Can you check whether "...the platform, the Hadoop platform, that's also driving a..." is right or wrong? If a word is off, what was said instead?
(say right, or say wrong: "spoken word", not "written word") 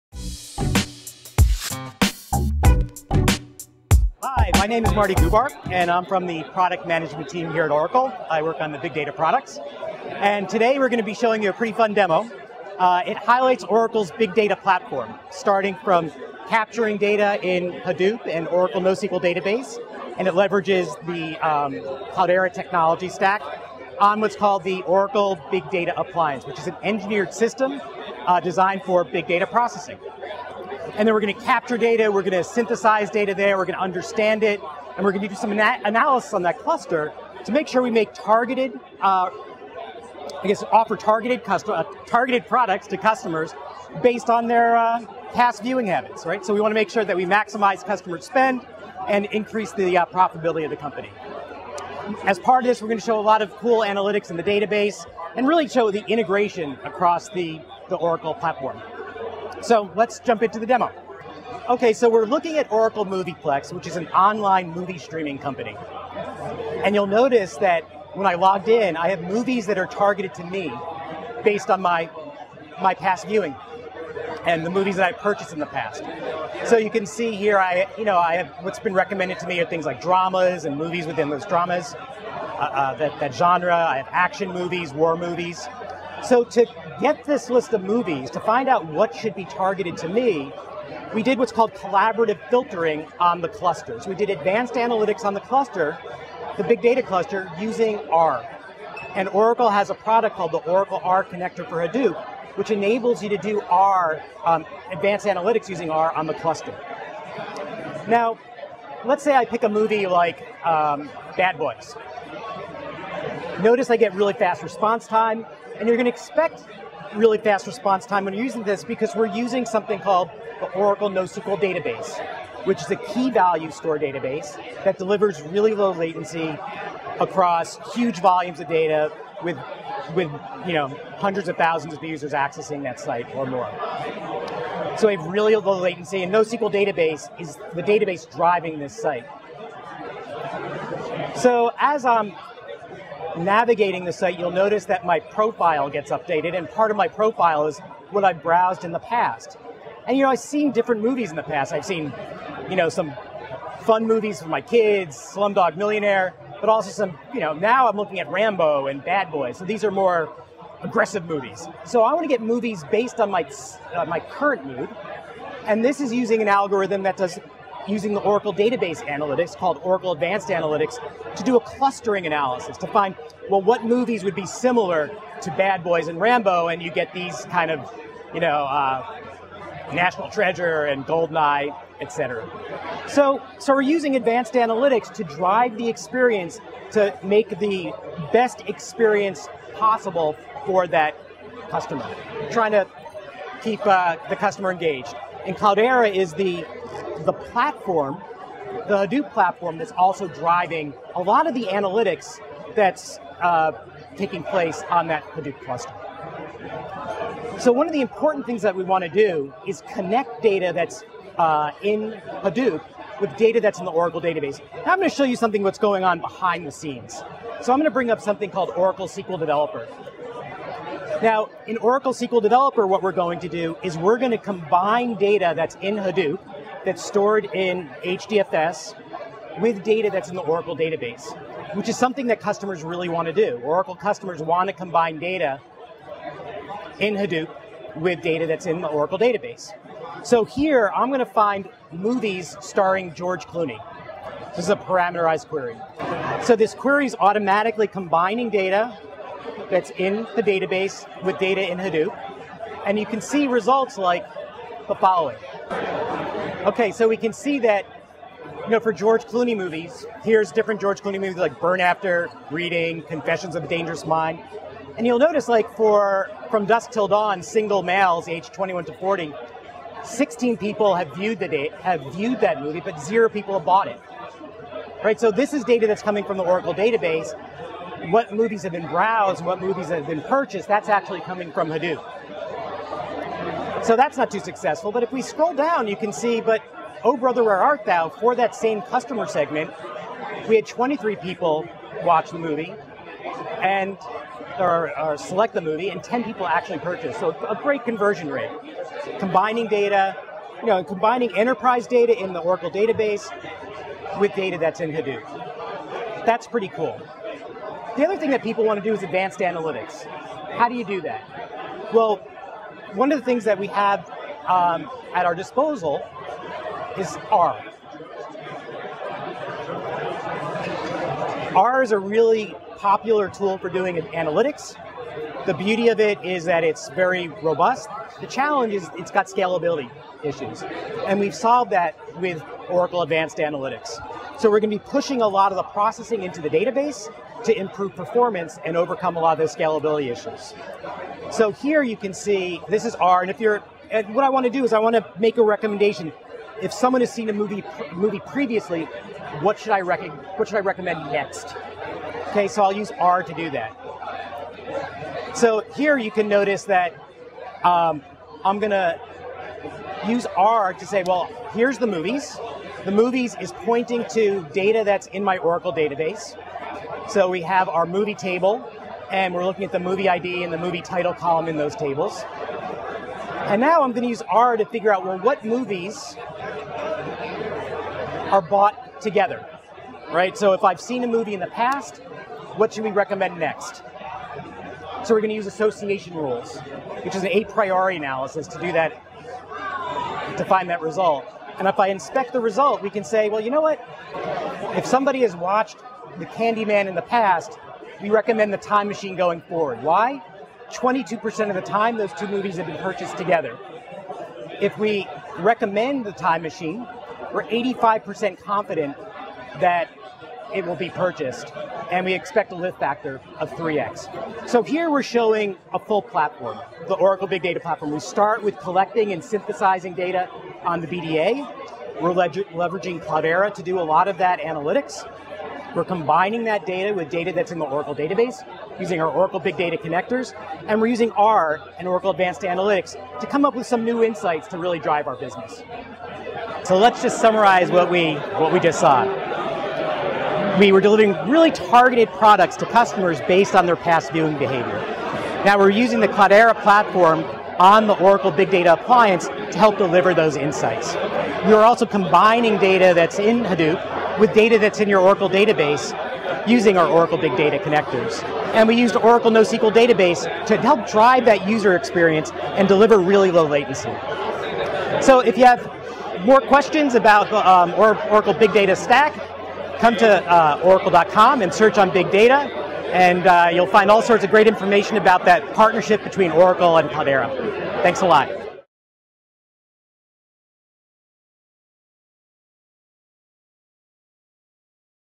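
right.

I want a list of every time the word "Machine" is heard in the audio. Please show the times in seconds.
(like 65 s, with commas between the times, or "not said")
398 s, 406 s.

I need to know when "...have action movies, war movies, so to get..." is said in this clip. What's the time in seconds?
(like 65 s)
83 s.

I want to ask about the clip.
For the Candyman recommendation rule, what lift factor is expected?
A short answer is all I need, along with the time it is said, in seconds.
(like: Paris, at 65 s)
3x, at 413 s.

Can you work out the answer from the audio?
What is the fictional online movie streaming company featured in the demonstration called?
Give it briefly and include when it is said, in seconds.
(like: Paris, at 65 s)
Oracle Movieplex, at 62 s.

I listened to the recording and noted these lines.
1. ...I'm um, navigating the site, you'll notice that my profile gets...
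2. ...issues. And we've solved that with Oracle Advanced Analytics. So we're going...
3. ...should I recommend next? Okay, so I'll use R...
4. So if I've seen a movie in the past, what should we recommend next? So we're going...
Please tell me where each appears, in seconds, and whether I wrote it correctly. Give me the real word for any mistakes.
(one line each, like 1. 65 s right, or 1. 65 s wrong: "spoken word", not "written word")
1. 142 s right
2. 330 s right
3. 350 s right
4. 380 s right.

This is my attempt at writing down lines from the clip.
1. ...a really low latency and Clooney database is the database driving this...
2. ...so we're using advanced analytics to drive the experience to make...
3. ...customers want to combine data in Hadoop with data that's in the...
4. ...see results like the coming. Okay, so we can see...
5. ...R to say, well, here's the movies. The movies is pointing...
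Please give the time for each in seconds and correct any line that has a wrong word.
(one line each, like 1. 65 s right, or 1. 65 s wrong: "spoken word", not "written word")
1. 135 s wrong: "NoSQL", not "Clooney"
2. 183 s right
3. 233 s right
4. 253 s wrong: "following", not "coming"
5. 360 s right.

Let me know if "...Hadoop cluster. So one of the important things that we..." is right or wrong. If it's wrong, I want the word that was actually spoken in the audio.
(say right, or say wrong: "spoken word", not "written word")
right.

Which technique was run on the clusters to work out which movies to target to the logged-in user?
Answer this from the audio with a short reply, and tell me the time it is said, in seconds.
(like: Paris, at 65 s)
Collaborative filtering, at 91 s.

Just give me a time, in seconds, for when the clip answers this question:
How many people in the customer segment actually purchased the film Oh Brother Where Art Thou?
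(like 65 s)
296 s.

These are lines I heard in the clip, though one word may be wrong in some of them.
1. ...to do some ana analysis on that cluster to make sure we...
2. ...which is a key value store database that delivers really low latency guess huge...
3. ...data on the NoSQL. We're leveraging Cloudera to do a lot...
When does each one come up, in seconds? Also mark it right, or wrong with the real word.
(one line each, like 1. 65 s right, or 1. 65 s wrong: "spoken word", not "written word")
1. 35 s right
2. 122 s wrong: "across", not "guess"
3. 419 s wrong: "BDA", not "NoSQL".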